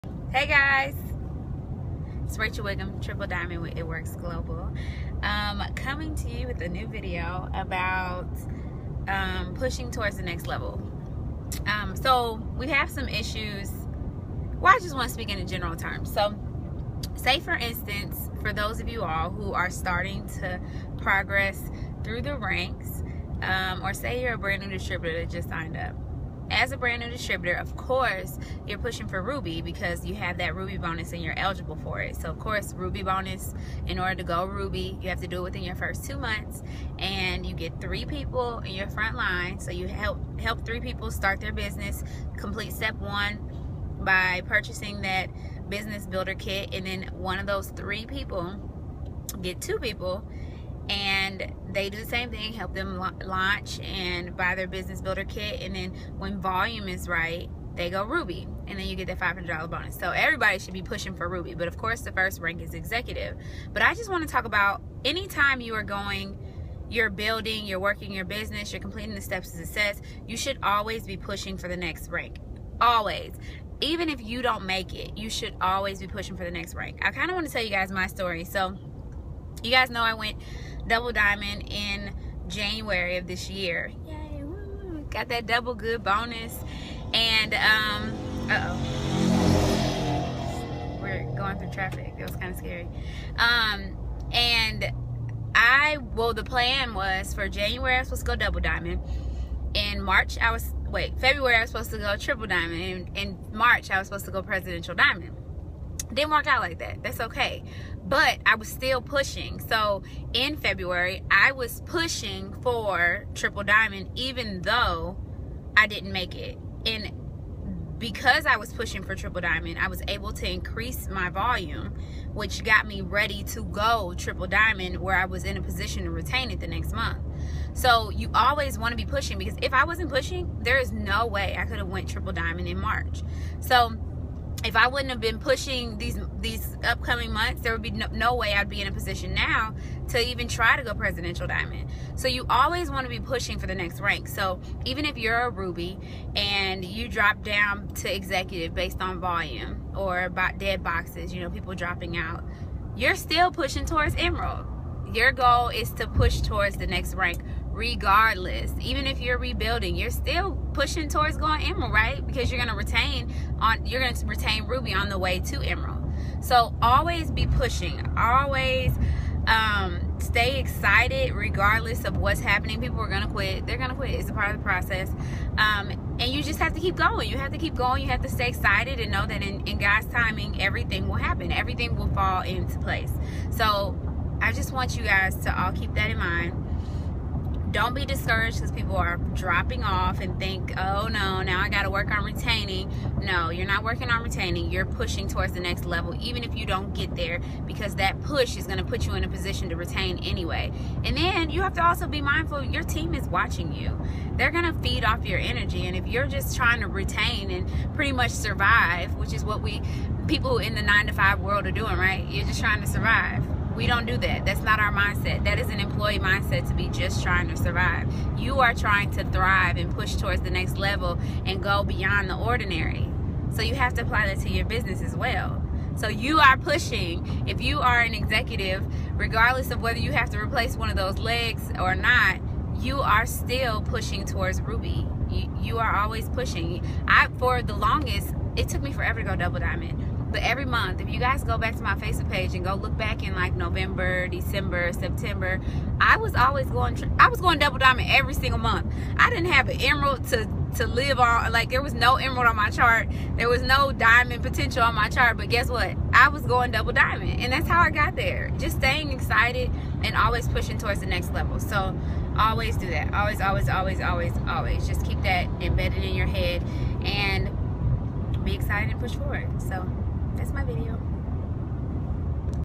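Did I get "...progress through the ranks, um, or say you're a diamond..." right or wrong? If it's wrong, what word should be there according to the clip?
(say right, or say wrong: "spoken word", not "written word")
wrong: "brand", not "diamond".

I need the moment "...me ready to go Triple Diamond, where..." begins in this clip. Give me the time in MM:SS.
02:02.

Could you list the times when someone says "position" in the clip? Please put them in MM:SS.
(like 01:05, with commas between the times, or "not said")
02:05, 02:18, 03:19.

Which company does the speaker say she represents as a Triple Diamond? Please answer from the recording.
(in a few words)
It Works Global.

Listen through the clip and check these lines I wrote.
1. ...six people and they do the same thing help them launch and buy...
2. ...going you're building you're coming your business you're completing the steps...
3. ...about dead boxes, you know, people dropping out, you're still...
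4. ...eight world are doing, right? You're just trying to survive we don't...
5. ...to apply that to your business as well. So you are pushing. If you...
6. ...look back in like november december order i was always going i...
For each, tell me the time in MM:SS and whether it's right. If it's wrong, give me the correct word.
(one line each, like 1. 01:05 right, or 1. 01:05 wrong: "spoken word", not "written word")
1. 00:49 wrong: "two", not "six"
2. 01:05 wrong: "working", not "coming"
3. 02:30 right
4. 03:31 wrong: "five", not "eight"
5. 03:43 right
6. 04:02 wrong: "september", not "order".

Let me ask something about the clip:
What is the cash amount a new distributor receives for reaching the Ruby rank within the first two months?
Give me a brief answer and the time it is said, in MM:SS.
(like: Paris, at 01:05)
$500, at 00:59.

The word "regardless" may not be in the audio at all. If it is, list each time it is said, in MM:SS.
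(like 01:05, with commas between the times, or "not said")
02:37, 02:51, 03:49.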